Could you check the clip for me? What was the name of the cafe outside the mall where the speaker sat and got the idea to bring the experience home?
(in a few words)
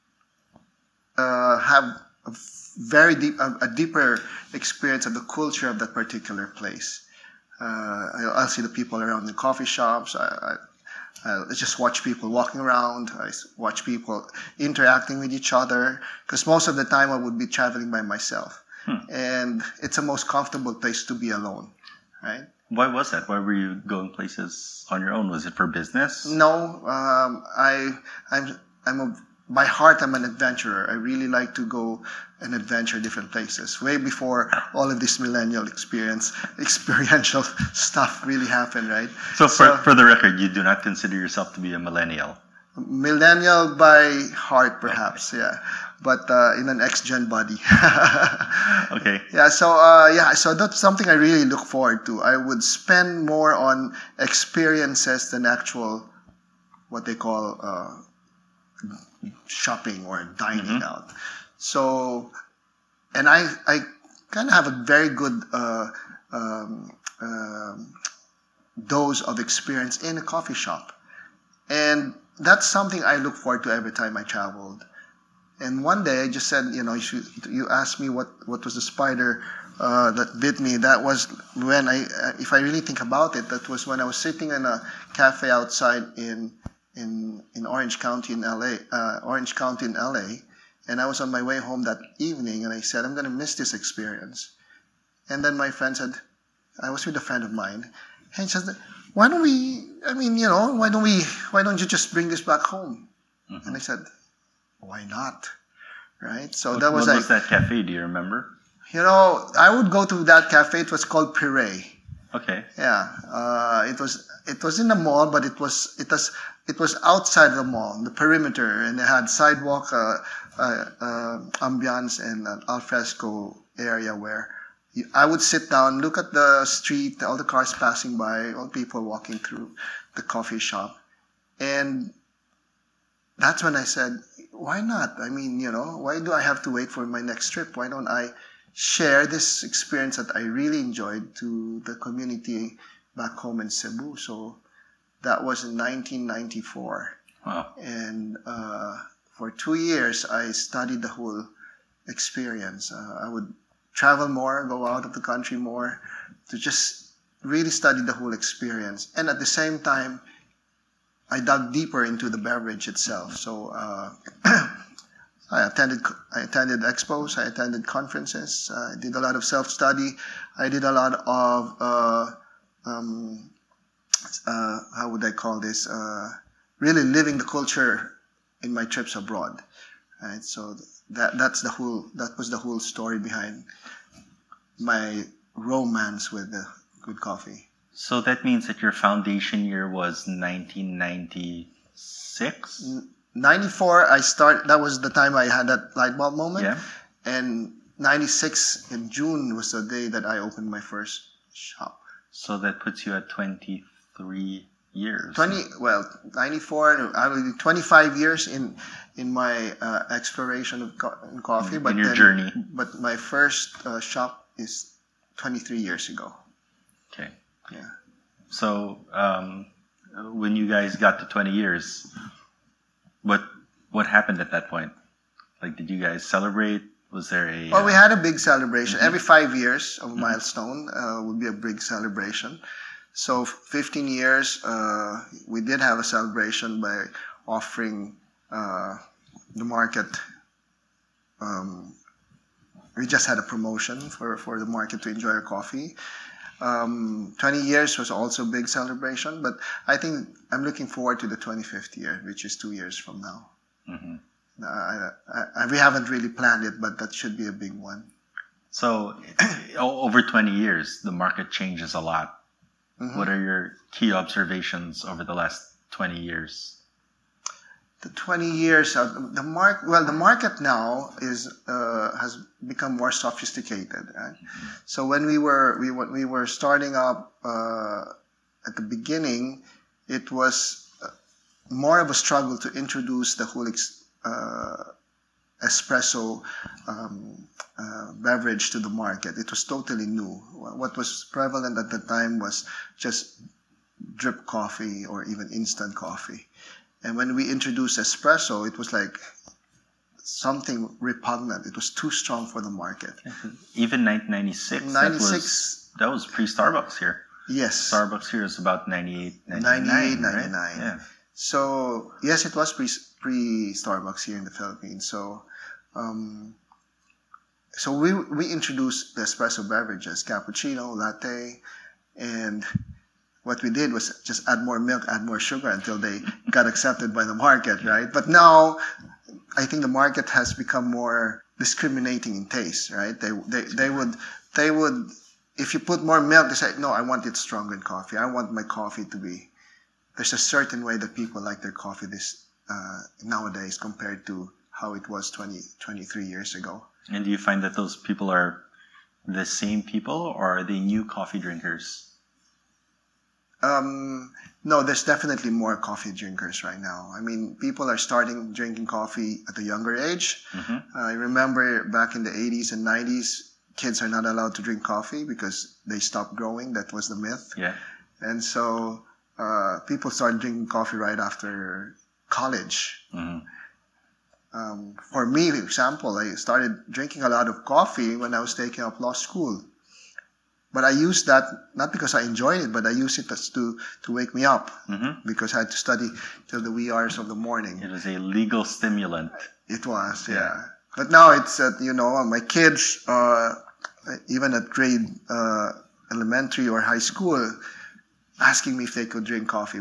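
Pire.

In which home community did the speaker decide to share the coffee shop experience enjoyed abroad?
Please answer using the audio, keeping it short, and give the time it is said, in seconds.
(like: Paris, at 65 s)
Cebu, at 143 s.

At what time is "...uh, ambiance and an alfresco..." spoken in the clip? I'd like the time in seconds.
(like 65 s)
120 s.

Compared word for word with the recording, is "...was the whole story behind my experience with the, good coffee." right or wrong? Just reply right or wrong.
wrong.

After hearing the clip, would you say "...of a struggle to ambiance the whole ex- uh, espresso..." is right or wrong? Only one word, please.
wrong.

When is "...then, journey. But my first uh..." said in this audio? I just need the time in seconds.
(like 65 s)
212 s.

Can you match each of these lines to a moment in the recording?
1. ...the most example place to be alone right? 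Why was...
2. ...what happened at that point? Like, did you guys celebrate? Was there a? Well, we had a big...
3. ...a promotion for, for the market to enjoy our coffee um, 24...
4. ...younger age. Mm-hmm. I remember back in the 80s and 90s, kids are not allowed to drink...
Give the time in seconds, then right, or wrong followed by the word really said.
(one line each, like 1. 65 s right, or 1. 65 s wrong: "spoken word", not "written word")
1. 19 s wrong: "comfortable", not "example"
2. 223 s right
3. 243 s wrong: "20", not "24"
4. 359 s right.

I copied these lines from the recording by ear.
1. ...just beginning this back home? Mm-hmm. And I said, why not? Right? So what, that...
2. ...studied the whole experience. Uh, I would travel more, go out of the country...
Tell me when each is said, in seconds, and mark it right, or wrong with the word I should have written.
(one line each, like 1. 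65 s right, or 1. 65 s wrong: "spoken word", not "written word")
1. 101 s wrong: "bring", not "beginning"
2. 150 s right.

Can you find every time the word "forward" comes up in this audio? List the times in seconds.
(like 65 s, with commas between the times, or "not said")
51 s, 73 s, 250 s.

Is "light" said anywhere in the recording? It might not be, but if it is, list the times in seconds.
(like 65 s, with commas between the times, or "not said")
195 s.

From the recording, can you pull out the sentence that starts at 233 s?
So 15 years, uh, we did have a celebration by offering uh, the market.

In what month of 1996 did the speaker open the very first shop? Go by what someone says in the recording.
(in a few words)
June.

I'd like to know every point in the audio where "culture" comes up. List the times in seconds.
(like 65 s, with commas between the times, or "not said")
5 s, 177 s.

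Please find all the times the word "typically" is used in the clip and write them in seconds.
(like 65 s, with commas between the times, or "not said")
not said.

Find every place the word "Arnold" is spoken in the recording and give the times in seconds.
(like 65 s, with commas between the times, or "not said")
not said.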